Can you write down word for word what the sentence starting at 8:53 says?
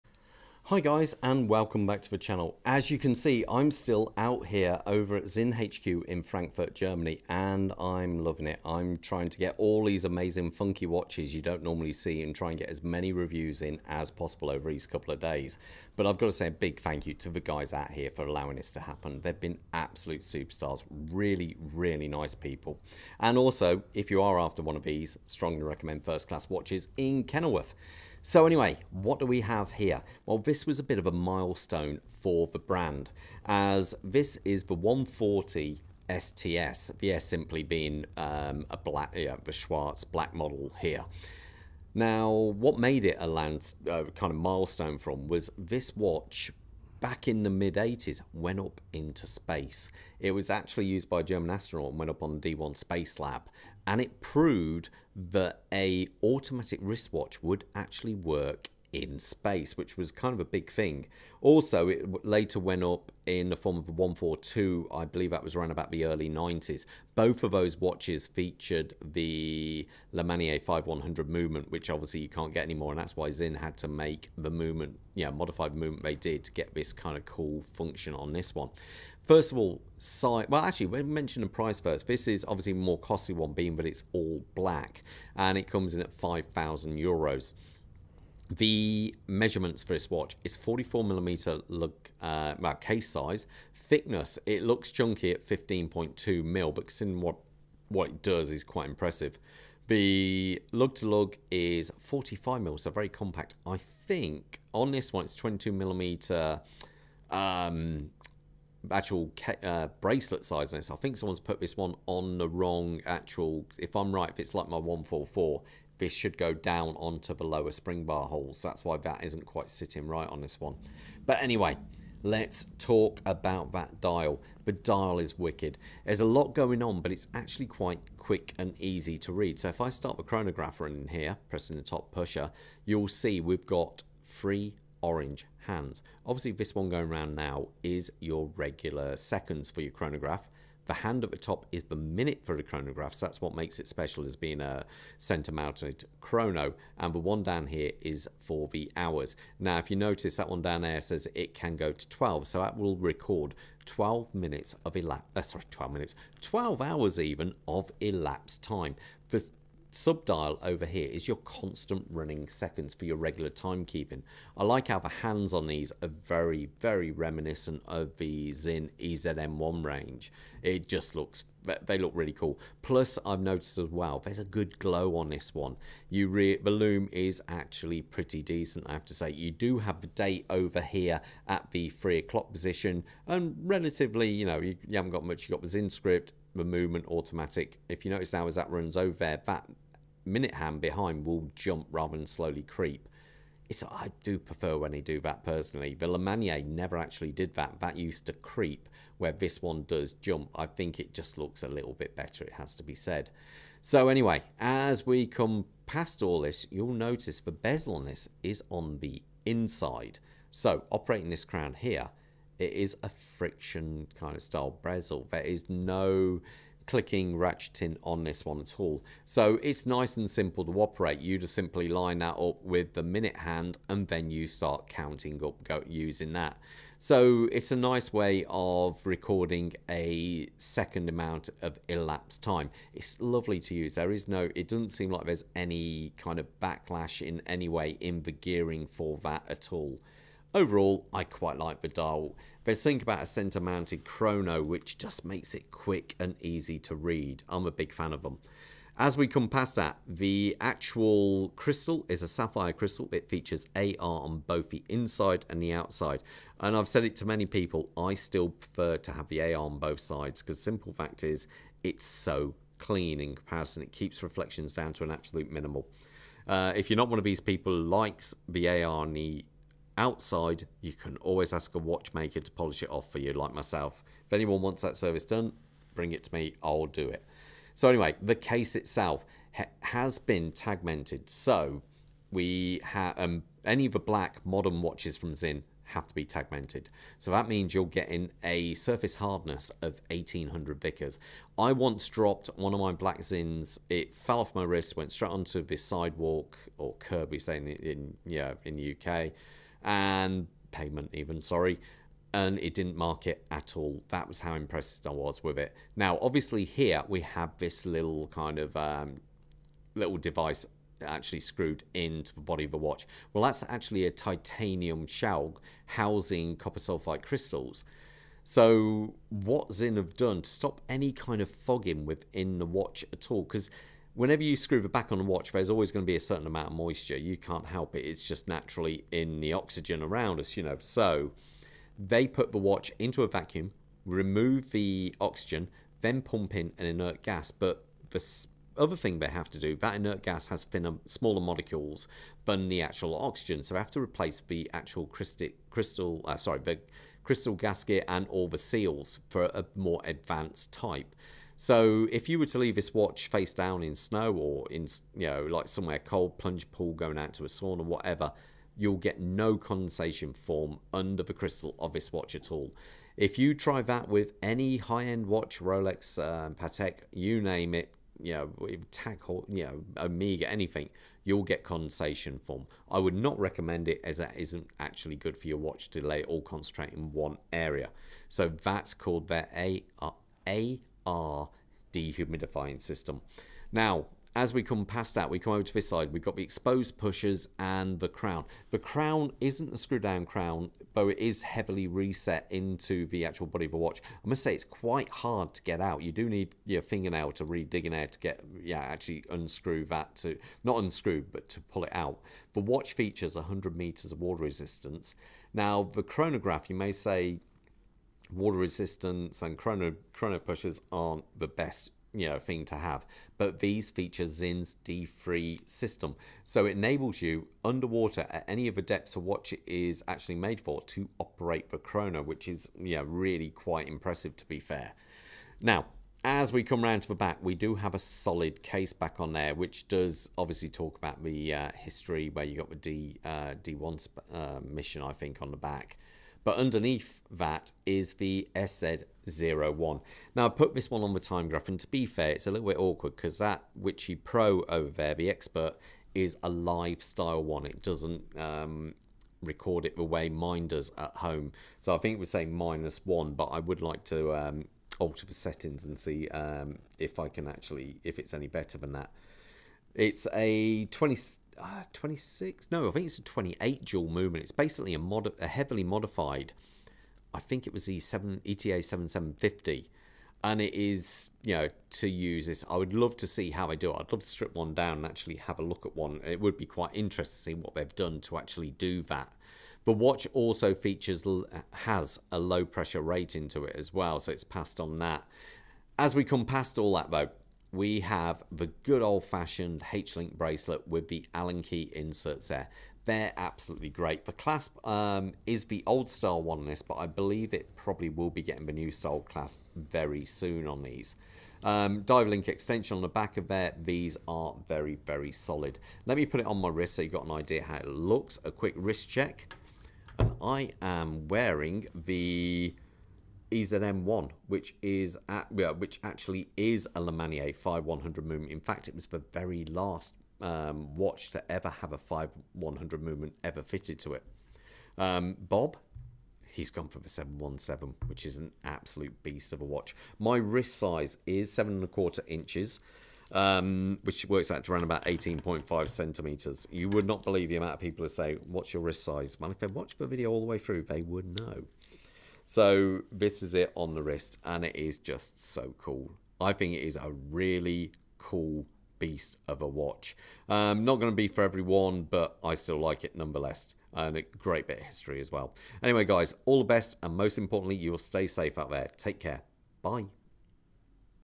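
Um, which works out to around about 18.5 centimeters.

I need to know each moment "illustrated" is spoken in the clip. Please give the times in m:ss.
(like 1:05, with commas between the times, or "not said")
not said.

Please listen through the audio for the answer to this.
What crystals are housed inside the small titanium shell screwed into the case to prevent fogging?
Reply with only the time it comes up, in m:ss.
5:16.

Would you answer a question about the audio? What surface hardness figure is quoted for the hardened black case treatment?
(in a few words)
1800 Vickers.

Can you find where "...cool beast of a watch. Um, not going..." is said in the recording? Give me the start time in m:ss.
9:08.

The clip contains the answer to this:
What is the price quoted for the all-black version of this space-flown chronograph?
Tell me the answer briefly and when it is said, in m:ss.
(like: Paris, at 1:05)
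5,000 euros, at 1:26.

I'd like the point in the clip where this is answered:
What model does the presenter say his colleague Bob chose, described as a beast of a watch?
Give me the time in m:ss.
8:47.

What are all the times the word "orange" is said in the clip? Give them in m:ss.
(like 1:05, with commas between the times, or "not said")
2:15.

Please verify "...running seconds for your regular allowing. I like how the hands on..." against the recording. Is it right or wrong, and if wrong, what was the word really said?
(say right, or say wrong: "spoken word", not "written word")
wrong: "timekeeping", not "allowing".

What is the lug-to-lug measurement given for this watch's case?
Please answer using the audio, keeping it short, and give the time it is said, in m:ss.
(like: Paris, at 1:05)
45 mm, at 1:41.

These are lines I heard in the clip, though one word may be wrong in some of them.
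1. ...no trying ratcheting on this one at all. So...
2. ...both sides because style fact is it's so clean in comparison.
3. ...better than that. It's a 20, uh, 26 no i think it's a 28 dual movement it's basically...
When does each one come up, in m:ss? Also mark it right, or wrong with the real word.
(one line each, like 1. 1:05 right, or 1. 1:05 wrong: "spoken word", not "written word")
1. 3:35 wrong: "clicking", not "trying"
2. 4:19 wrong: "simple", not "style"
3. 7:38 right.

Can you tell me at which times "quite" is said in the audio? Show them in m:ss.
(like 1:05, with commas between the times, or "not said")
1:38, 1:59, 2:07, 4:01, 6:34, 7:03, 7:56.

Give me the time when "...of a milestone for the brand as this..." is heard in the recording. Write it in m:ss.
0:30.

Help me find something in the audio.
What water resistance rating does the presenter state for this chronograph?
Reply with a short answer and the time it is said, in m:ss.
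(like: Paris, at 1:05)
100 meters, at 6:43.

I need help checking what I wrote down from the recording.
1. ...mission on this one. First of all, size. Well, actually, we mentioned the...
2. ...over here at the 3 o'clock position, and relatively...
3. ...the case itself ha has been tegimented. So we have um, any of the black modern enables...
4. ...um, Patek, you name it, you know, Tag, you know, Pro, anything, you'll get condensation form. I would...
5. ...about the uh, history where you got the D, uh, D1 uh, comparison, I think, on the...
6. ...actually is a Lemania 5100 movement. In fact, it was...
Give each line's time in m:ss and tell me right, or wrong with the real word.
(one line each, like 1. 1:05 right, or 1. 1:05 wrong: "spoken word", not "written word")
1. 1:17 wrong: "function", not "mission"
2. 3:00 right
3. 4:38 wrong: "watches", not "enables"
4. 6:06 wrong: "Omega", not "Pro"
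5. 7:10 wrong: "mission", not "comparison"
6. 8:36 right.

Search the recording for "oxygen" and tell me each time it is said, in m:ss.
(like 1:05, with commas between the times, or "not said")
5:29, 5:35, 5:43.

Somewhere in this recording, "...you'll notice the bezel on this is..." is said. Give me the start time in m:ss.
3:26.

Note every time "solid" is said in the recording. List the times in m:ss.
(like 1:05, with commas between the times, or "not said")
7:07, 8:25.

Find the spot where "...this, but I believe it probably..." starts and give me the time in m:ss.
8:16.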